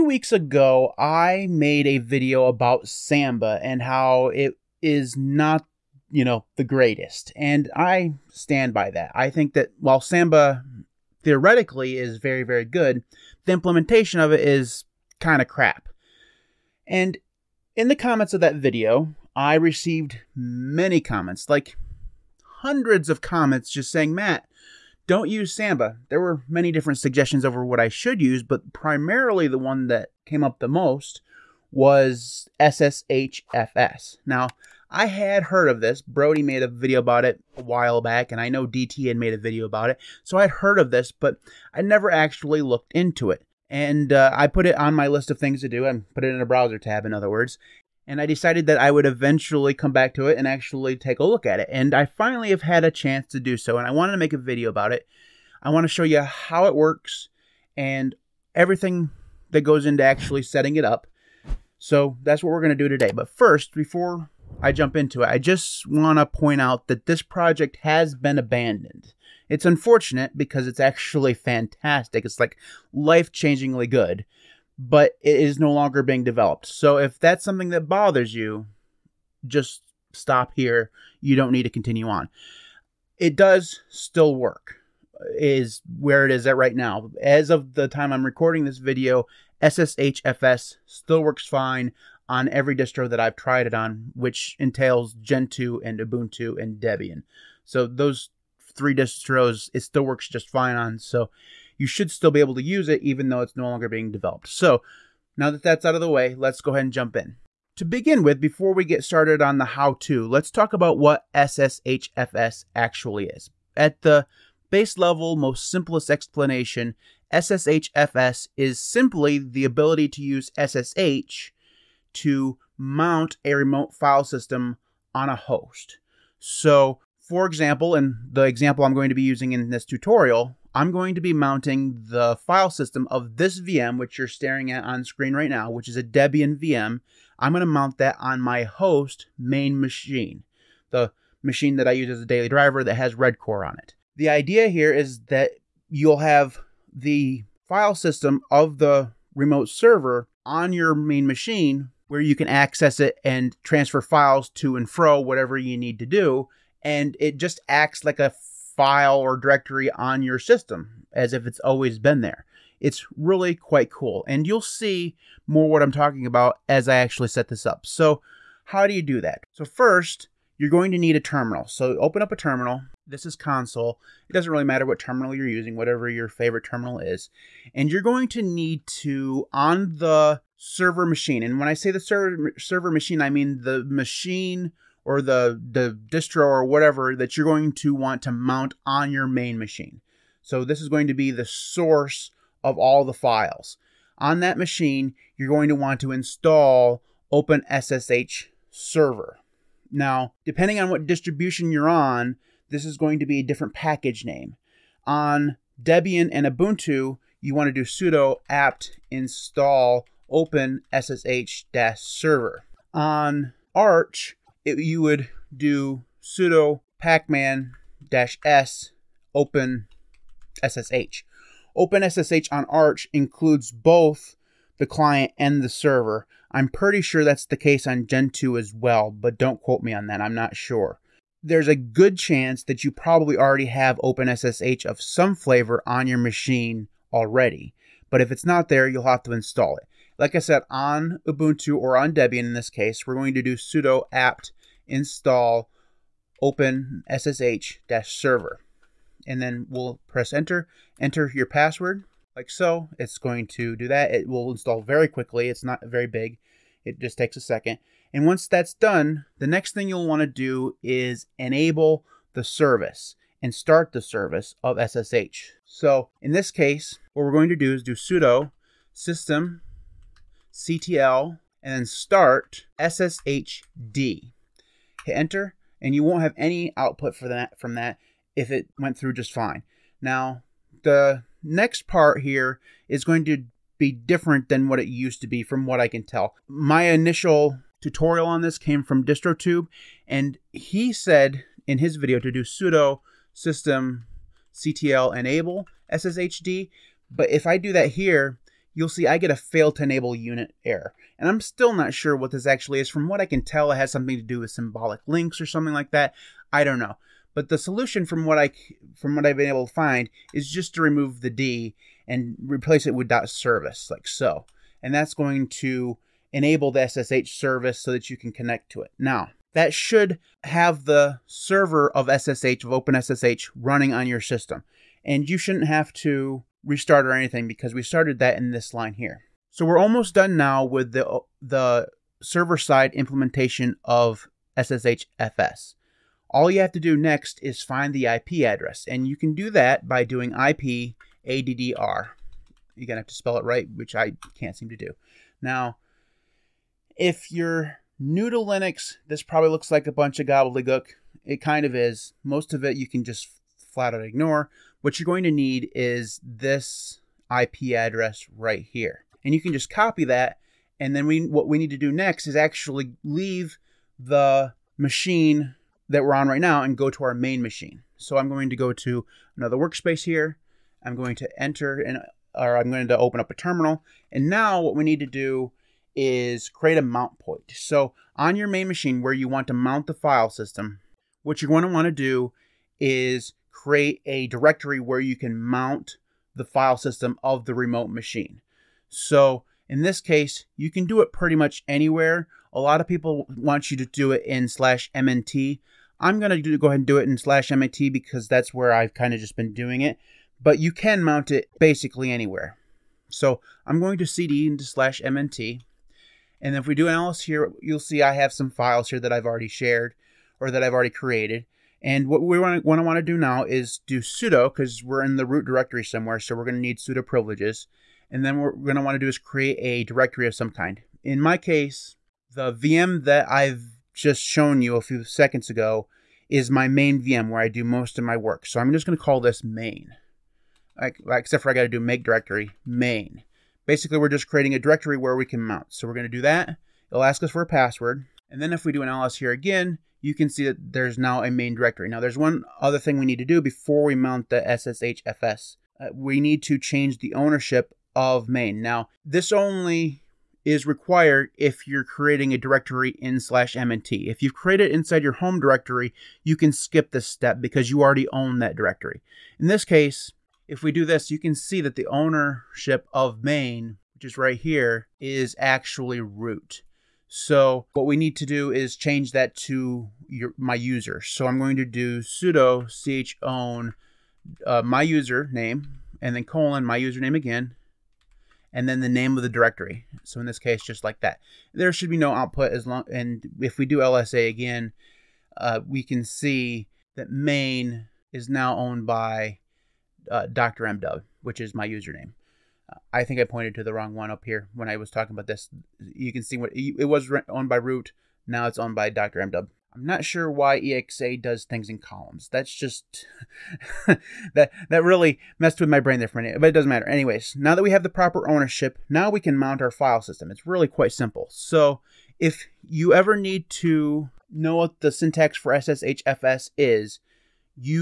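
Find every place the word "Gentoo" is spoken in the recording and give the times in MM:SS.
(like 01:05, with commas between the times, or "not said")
01:35, 03:48.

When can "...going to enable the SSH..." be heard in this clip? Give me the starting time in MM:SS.
05:15.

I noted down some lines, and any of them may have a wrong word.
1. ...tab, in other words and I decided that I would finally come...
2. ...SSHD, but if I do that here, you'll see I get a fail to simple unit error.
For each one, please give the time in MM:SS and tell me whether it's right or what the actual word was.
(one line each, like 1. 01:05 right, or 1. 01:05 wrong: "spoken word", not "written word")
1. 00:46 wrong: "eventually", not "finally"
2. 04:55 wrong: "enable", not "simple".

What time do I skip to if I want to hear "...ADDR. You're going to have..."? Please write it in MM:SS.
05:41.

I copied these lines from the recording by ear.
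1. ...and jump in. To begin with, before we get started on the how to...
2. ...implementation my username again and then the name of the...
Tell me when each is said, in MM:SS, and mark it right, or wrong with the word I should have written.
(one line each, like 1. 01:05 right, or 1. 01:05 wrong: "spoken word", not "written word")
1. 01:46 right
2. 07:56 wrong: "colon", not "implementation".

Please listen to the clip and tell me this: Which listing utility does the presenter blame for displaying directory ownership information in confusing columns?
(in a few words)
EXA.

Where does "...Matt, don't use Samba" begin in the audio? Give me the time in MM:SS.
00:24.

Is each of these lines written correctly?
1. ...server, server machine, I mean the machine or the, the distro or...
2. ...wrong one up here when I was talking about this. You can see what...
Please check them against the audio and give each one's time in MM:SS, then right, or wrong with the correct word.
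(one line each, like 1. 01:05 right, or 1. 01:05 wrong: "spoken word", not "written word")
1. 03:01 right
2. 08:13 right.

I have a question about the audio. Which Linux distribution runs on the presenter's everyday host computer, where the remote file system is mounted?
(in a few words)
Redcore.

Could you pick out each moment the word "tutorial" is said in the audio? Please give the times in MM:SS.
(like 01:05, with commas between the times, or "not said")
02:09, 04:47.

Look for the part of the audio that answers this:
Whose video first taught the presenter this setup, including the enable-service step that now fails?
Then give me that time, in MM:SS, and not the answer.
04:49.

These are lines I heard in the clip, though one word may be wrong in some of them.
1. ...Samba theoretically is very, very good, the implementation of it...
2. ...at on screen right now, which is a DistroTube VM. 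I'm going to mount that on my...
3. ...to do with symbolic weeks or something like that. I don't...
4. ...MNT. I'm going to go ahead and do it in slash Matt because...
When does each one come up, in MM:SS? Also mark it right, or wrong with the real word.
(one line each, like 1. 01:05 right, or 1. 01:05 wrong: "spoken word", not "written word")
1. 00:10 right
2. 02:14 wrong: "Debian", not "DistroTube"
3. 05:04 wrong: "links", not "weeks"
4. 06:34 wrong: "MNT", not "Matt".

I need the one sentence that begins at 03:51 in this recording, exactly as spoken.
There's a good chance that you probably already have OpenSSH of some flavor on your machine already.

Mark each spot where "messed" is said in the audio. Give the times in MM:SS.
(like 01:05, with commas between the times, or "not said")
08:25.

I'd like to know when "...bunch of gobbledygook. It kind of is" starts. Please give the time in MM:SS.
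05:49.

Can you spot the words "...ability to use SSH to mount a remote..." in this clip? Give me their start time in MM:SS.
01:59.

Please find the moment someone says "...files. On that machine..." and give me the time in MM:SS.
03:13.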